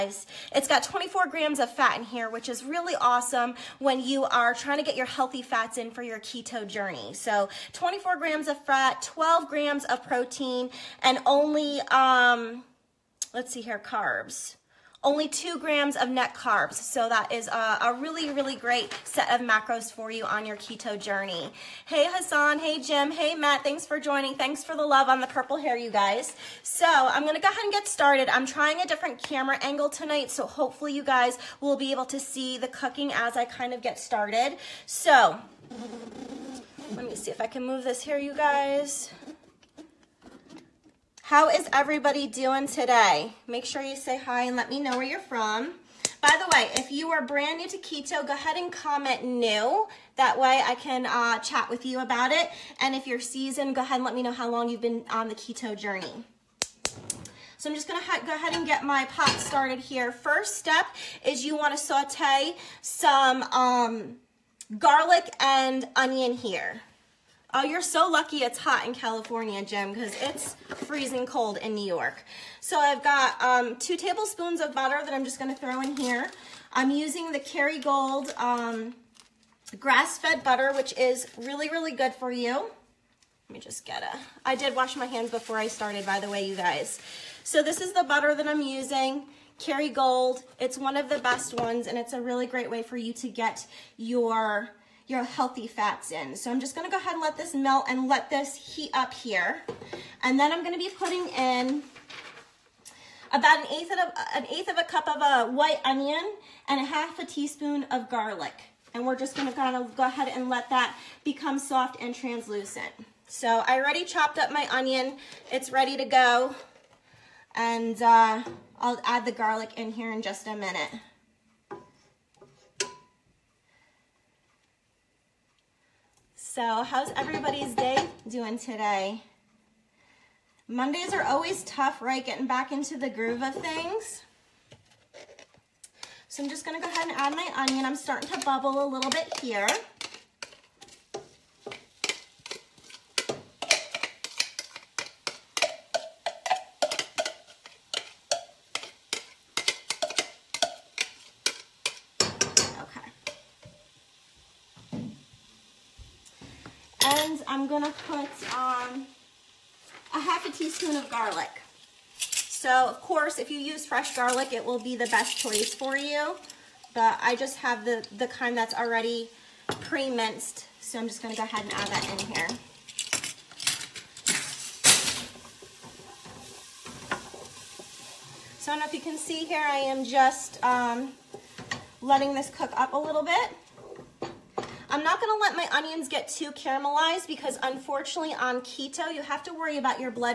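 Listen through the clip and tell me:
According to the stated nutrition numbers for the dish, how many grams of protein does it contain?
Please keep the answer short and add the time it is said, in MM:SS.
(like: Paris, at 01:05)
12 grams, at 00:09.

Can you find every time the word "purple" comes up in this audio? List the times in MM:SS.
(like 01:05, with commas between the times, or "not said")
00:25.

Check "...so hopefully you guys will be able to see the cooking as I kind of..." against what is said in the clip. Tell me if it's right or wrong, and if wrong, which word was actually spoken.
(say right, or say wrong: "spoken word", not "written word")
right.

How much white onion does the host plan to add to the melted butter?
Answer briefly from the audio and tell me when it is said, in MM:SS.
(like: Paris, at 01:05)
1/8 cup, at 01:44.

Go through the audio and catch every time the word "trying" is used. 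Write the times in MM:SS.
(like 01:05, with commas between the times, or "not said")
00:04, 00:28.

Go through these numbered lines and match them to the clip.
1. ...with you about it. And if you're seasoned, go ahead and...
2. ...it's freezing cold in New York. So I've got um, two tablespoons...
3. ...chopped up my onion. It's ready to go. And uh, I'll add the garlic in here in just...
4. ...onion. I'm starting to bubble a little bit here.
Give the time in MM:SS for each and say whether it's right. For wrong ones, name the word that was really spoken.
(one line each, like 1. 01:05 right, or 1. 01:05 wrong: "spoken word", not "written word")
1. 00:51 right
2. 01:10 right
3. 01:54 right
4. 02:17 right.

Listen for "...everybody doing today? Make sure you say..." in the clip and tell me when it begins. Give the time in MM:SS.
00:41.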